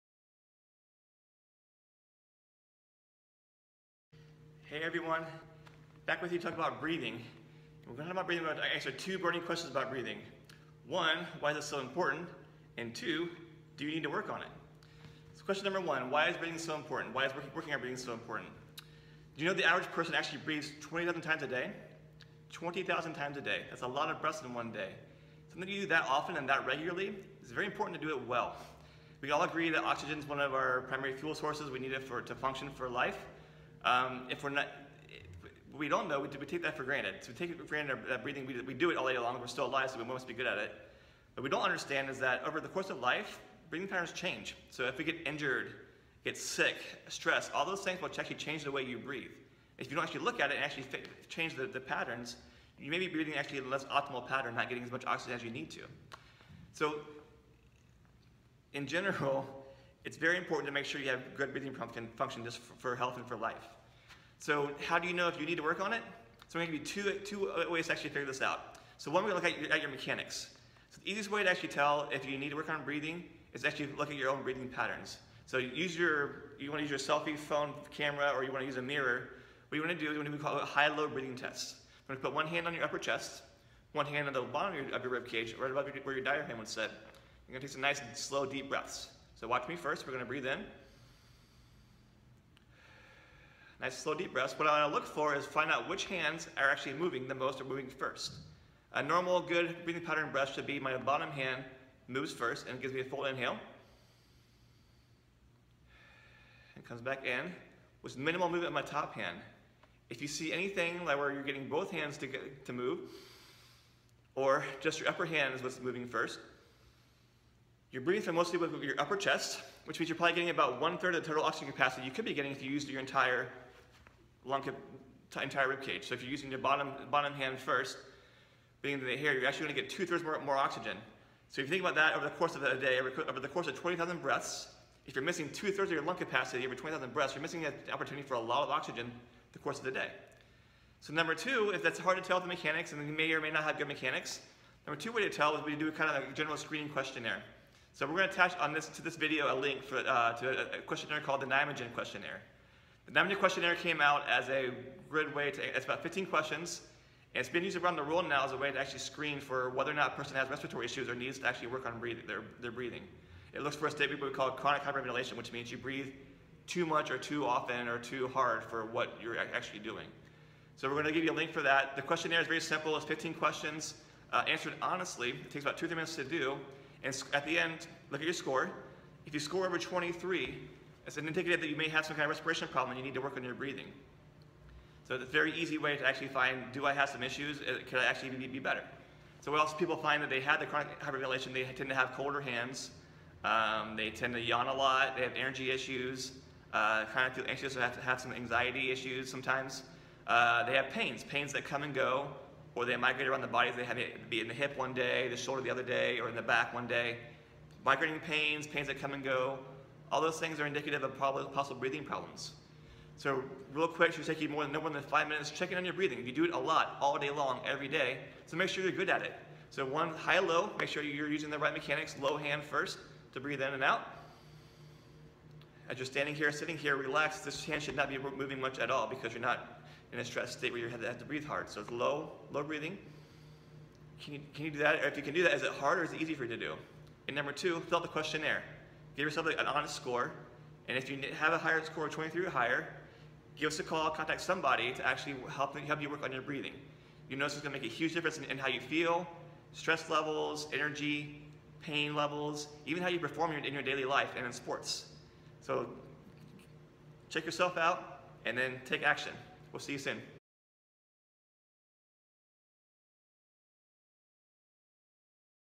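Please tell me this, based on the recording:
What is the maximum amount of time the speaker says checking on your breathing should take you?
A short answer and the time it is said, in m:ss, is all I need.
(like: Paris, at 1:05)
5 minutes, at 3:35.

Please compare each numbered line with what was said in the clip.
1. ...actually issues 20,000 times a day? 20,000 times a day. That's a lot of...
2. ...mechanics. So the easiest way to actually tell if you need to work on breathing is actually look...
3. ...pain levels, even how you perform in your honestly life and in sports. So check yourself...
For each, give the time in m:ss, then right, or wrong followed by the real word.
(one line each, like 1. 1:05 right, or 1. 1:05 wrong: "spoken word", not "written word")
1. 0:20 wrong: "breathes", not "issues"
2. 1:09 right
3. 4:11 wrong: "daily", not "honestly".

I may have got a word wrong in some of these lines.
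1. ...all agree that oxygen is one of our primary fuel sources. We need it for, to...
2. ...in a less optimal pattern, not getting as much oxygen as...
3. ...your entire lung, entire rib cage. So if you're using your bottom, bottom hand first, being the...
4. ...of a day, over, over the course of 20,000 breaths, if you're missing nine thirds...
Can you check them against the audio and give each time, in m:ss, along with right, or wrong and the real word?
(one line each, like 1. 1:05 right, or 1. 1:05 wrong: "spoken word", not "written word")
1. 0:29 right
2. 0:53 right
3. 2:02 right
4. 2:12 wrong: "two", not "nine".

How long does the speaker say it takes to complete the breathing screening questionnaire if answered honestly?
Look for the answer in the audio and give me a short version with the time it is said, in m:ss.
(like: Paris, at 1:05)
2-3 minutes, at 2:55.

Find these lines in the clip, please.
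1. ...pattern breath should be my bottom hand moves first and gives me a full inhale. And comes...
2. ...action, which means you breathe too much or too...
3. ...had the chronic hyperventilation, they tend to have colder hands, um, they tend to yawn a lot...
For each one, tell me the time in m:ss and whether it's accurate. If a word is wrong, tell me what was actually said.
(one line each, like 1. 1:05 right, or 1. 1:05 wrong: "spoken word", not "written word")
1. 1:40 right
2. 2:44 wrong: "hyperventilation", not "action"
3. 3:10 right.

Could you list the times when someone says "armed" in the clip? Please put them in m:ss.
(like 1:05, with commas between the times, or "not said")
not said.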